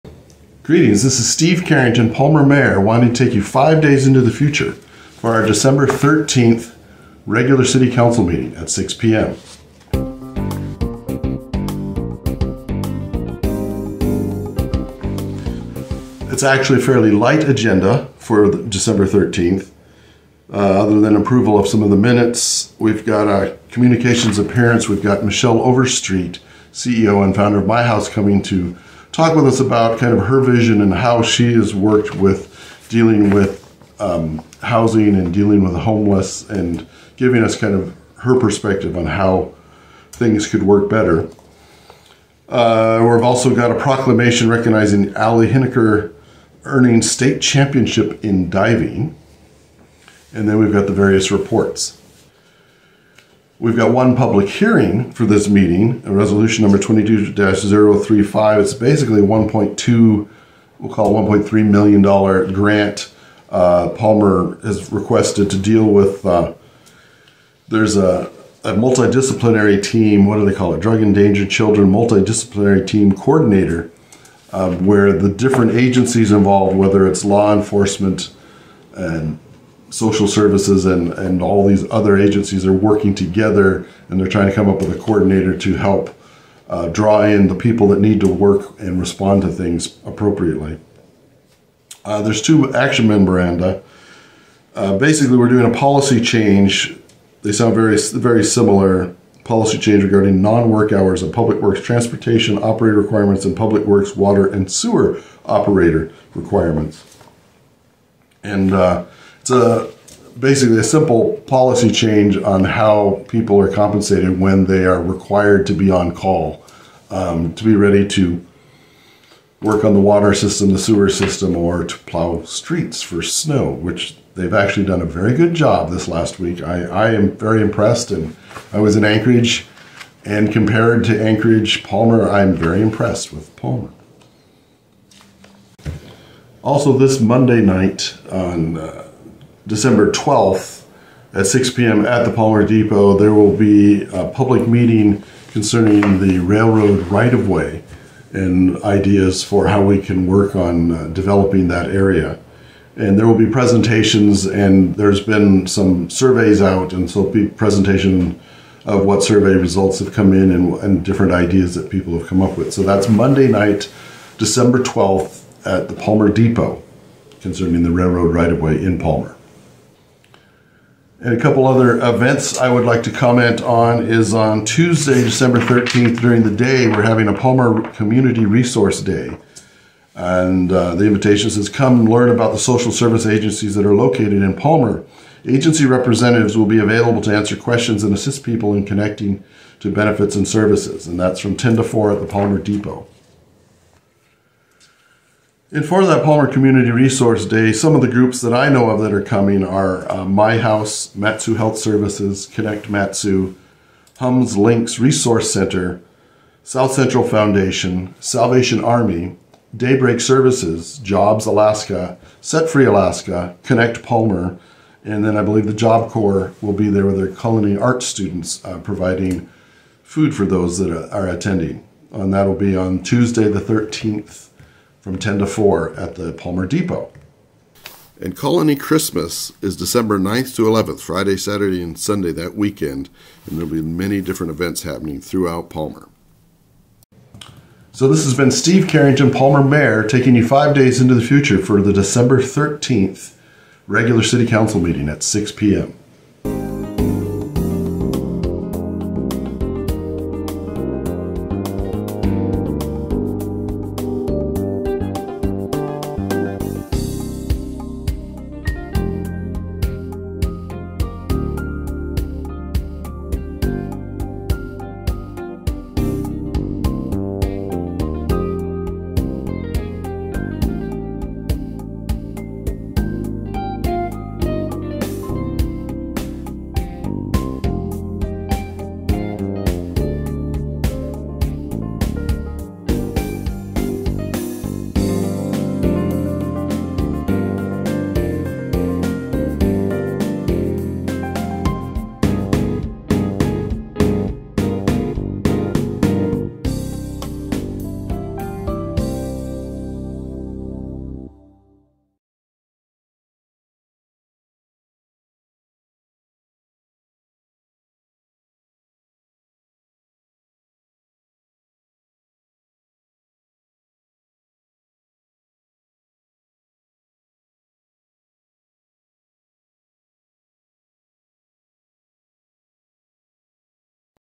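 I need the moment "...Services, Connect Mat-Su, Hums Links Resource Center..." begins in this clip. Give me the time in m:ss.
3:21.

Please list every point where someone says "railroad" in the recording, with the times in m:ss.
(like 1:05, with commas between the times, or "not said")
2:26, 2:47.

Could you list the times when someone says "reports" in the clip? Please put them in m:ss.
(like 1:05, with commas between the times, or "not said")
0:51.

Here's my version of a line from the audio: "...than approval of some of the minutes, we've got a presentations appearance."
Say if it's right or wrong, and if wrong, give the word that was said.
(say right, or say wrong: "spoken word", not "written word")
wrong: "communications", not "presentations".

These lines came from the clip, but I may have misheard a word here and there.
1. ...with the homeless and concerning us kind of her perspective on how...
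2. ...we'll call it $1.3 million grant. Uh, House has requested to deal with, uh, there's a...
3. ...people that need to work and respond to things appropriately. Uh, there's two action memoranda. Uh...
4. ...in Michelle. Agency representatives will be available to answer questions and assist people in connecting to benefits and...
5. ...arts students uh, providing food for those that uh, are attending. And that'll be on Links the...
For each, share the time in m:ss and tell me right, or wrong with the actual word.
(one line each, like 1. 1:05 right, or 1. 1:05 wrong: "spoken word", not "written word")
1. 0:35 wrong: "giving", not "concerning"
2. 1:00 wrong: "Palmer", not "House"
3. 1:27 right
4. 3:04 wrong: "Palmer", not "Michelle"
5. 3:37 wrong: "Tuesday", not "Links".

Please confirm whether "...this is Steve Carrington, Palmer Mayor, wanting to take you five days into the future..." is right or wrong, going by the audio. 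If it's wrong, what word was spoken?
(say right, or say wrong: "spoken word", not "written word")
right.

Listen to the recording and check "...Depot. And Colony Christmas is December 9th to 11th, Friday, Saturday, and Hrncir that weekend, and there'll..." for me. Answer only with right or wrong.
wrong.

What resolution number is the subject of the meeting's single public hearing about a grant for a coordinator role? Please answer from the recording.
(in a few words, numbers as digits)
22-035.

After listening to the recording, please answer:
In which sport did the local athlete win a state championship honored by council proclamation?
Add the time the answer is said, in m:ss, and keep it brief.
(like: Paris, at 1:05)
Diving, at 0:48.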